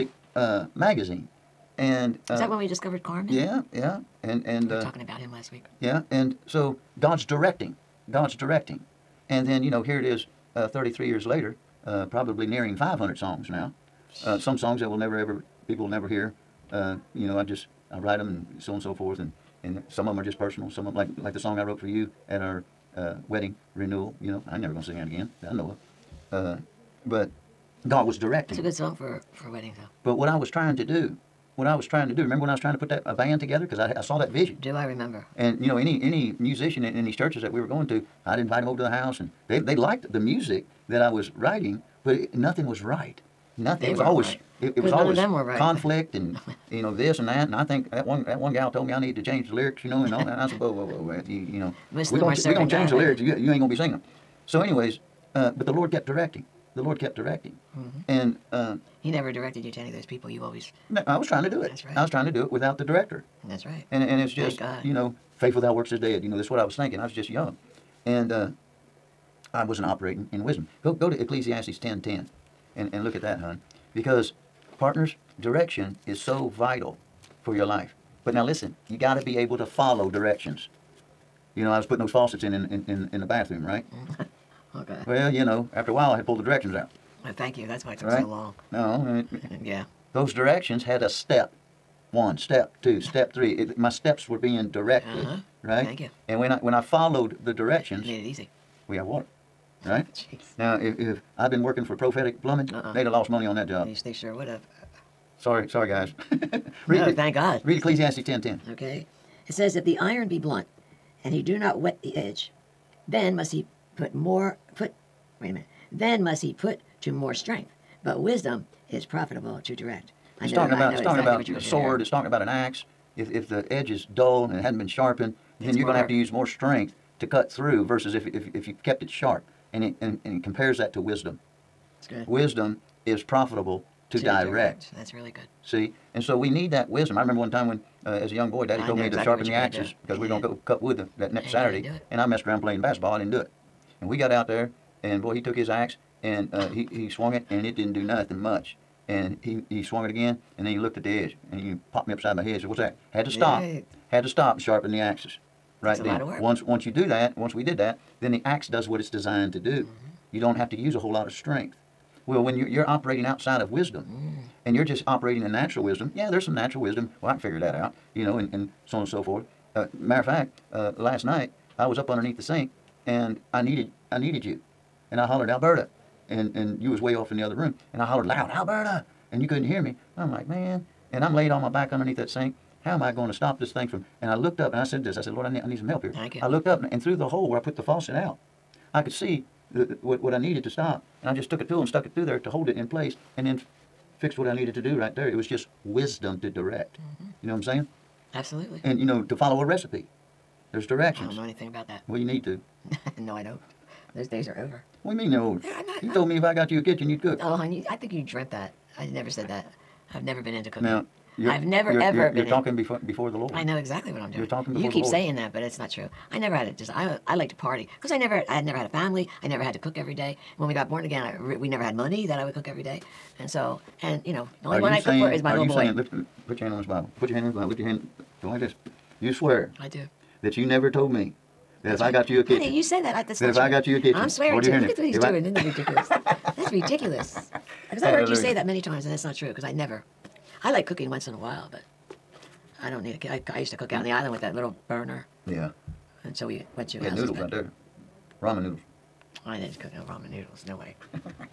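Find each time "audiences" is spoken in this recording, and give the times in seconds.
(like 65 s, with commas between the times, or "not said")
not said.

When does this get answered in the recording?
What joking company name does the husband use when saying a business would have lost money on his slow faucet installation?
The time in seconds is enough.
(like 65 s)
101 s.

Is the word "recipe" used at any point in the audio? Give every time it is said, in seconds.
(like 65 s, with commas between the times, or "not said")
199 s.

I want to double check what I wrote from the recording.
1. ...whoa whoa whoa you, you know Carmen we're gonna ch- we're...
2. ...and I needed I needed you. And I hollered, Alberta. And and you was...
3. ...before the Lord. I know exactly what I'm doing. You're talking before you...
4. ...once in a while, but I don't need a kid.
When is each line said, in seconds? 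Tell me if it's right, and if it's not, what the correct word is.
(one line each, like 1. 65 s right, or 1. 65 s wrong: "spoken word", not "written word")
1. 50 s wrong: "Most", not "Carmen"
2. 173 s right
3. 212 s right
4. 241 s right.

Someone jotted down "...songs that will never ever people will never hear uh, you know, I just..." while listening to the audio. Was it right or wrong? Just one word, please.
right.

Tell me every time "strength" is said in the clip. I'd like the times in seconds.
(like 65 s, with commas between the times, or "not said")
117 s, 126 s, 161 s.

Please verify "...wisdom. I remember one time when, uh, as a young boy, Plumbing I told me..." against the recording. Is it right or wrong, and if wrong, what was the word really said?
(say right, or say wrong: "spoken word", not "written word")
wrong: "Daddy", not "Plumbing".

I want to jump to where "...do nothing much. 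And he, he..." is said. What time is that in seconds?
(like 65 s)
147 s.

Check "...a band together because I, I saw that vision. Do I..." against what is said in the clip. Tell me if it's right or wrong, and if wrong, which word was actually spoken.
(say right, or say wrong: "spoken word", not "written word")
right.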